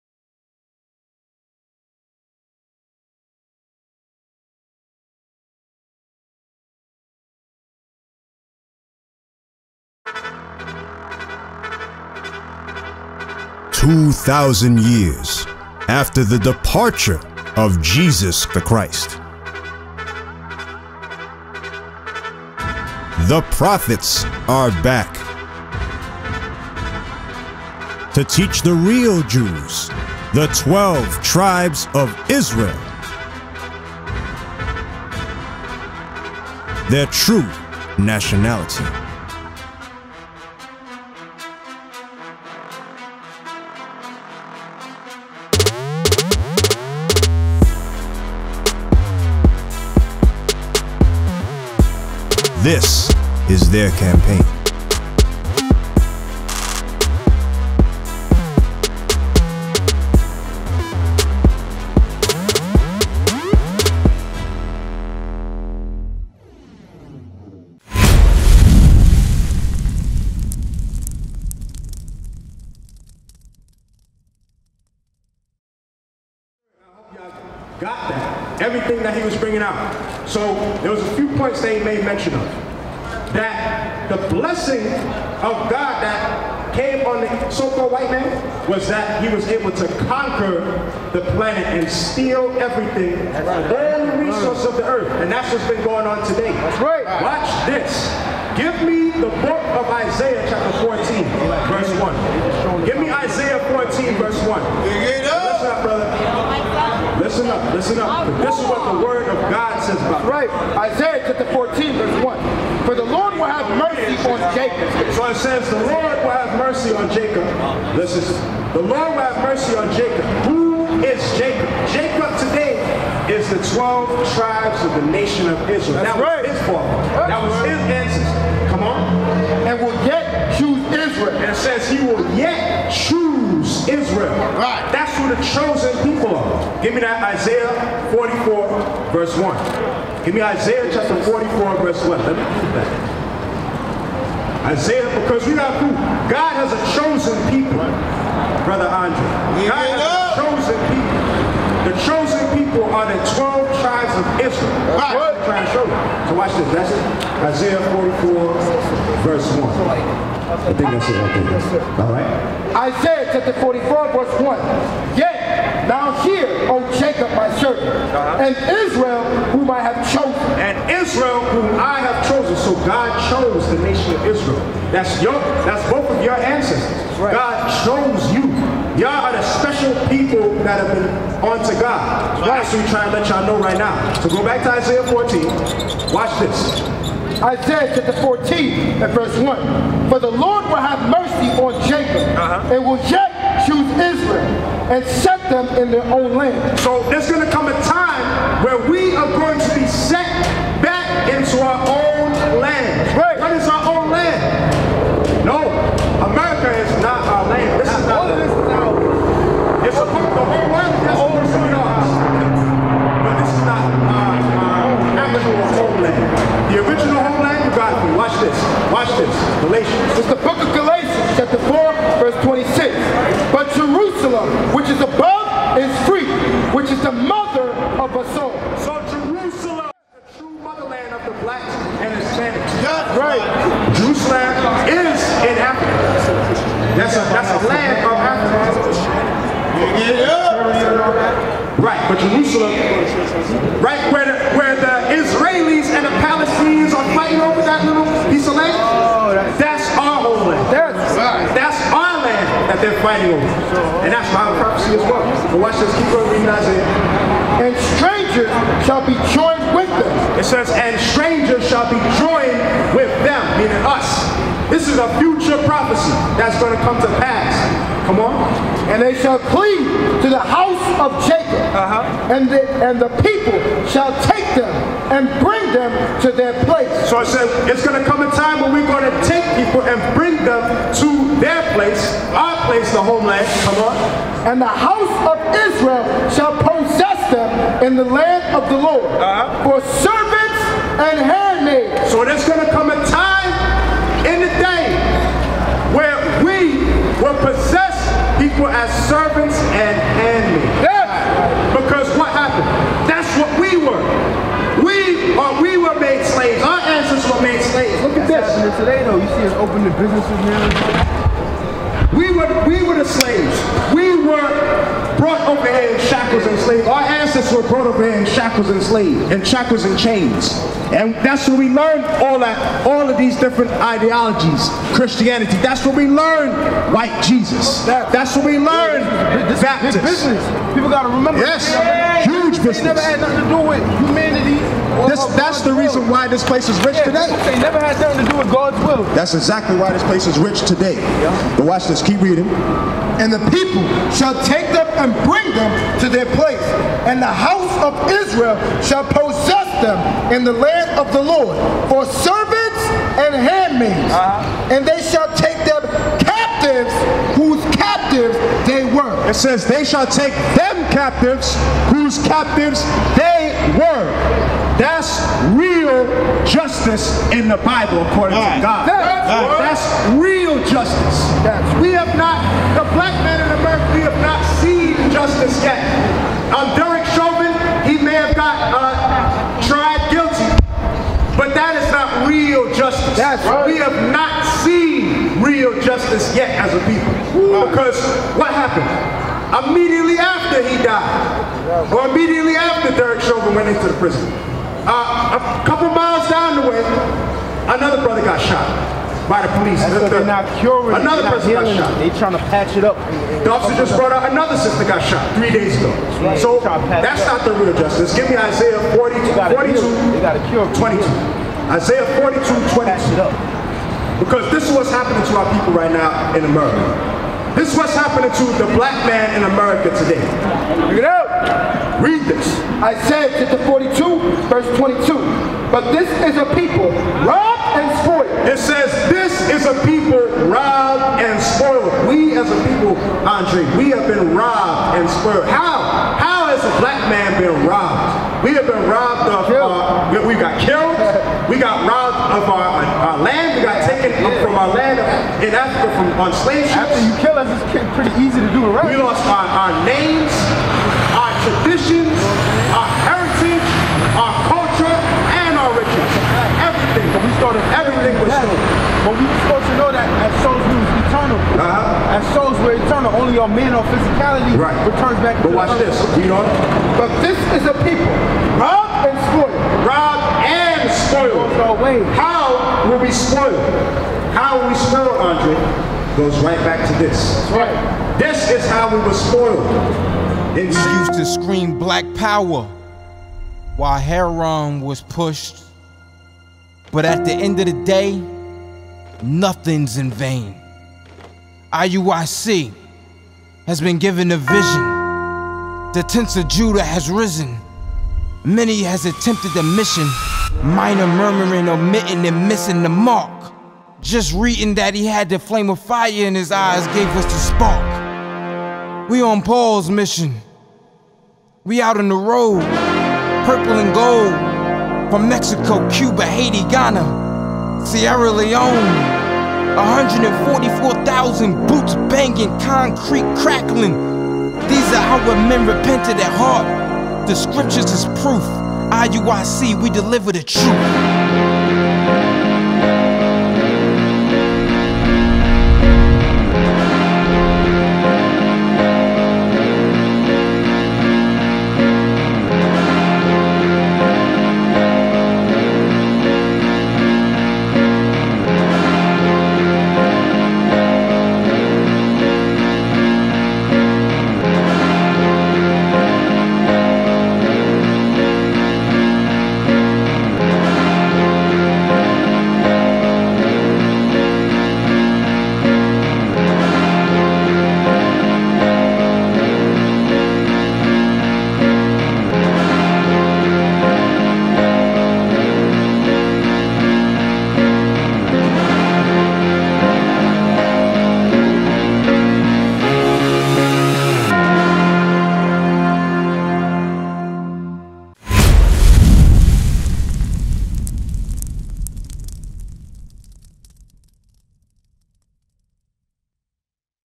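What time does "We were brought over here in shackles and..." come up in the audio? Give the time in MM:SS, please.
05:13.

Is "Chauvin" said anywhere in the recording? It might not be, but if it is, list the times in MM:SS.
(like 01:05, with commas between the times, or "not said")
06:17, 06:33.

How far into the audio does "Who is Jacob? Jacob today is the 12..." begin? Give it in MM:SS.
02:00.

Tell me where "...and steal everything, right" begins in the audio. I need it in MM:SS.
01:31.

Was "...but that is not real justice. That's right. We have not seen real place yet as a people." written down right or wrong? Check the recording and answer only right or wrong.
wrong.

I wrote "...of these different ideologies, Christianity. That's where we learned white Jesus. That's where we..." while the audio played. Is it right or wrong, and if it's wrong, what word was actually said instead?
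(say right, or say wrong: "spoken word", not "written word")
right.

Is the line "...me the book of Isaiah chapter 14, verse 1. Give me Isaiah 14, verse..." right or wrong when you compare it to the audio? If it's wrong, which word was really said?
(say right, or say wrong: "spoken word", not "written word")
right.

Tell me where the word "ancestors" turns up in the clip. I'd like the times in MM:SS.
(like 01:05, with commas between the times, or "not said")
02:07, 02:56, 05:06, 05:17.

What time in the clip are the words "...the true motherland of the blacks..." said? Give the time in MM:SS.
03:50.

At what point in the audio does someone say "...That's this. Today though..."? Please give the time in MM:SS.
05:08.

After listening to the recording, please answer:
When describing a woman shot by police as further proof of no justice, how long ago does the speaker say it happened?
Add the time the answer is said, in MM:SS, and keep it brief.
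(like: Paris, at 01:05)
three days ago, at 06:45.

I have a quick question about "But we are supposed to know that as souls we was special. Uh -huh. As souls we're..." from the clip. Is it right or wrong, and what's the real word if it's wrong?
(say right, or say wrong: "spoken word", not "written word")
wrong: "eternal", not "special".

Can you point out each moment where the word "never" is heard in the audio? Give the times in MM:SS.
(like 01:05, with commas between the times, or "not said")
05:32, 05:37.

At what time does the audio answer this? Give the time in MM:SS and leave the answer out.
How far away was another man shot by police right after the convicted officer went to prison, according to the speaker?
06:35.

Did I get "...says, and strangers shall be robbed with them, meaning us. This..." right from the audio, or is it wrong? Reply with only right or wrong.
wrong.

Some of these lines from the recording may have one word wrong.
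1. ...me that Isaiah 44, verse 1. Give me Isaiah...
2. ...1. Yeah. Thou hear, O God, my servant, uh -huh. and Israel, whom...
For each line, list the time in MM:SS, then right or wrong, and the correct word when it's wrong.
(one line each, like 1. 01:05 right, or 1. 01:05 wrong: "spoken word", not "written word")
1. 02:16 right
2. 02:44 wrong: "Jacob", not "God".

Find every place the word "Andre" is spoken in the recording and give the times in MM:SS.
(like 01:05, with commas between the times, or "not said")
02:28, 07:13, 07:55.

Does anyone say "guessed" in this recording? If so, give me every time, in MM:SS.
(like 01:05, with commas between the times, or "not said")
not said.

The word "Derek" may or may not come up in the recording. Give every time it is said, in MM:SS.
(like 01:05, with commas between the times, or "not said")
06:16, 06:32.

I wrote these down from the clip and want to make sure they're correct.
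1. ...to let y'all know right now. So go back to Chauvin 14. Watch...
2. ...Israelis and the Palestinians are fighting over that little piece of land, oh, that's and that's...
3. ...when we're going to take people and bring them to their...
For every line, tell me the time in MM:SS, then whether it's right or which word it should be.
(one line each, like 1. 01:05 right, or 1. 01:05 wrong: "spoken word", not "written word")
1. 03:03 wrong: "Isaiah", not "Chauvin"
2. 04:05 right
3. 04:38 right.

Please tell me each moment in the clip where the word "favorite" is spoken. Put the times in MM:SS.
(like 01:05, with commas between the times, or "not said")
not said.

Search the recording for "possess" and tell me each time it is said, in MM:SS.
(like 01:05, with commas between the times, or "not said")
04:46, 04:57, 05:49.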